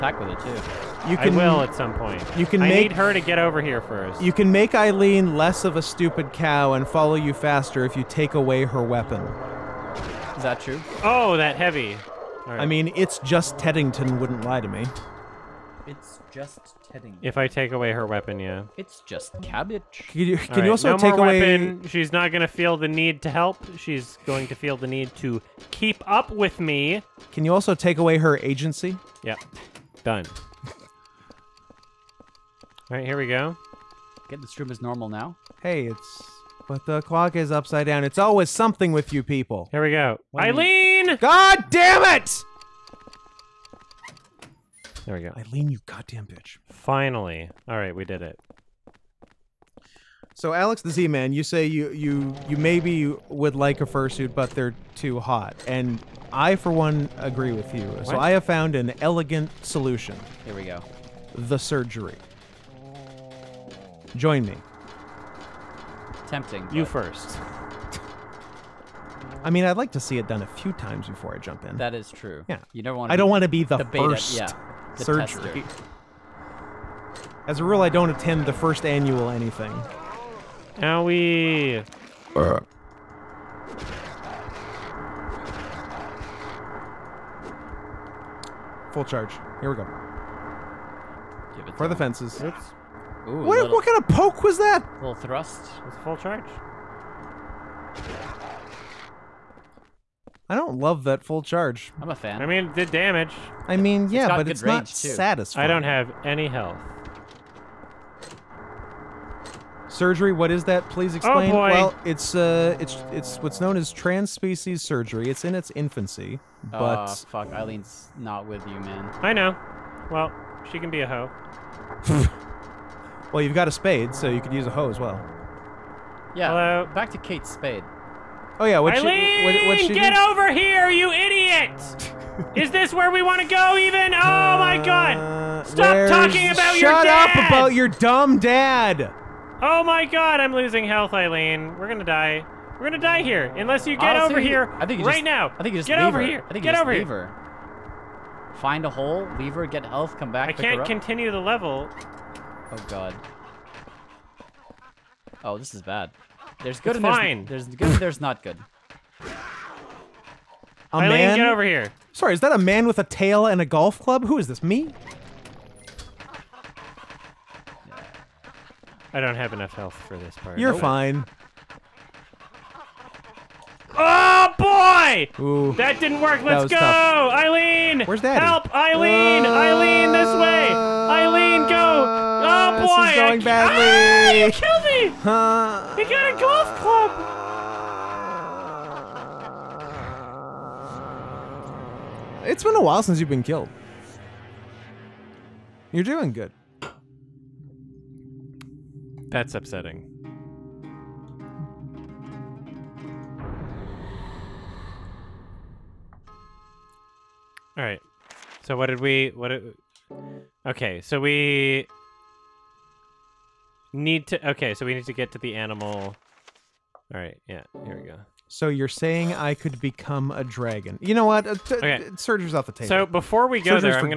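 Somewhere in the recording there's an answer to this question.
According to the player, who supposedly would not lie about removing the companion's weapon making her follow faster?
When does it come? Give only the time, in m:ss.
0:13.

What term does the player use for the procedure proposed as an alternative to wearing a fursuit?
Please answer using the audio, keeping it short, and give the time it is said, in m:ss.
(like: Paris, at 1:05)
trans-species surgery, at 1:53.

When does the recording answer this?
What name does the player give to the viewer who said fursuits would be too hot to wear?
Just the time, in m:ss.
0:50.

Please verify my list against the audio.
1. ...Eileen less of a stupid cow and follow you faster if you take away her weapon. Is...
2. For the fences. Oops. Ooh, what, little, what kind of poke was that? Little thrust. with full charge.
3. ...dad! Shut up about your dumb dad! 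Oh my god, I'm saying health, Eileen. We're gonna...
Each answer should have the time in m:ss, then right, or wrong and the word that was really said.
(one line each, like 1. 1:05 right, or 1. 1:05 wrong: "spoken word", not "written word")
1. 0:04 right
2. 1:31 right
3. 2:17 wrong: "losing", not "saying".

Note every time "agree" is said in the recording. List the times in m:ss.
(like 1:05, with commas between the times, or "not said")
0:57.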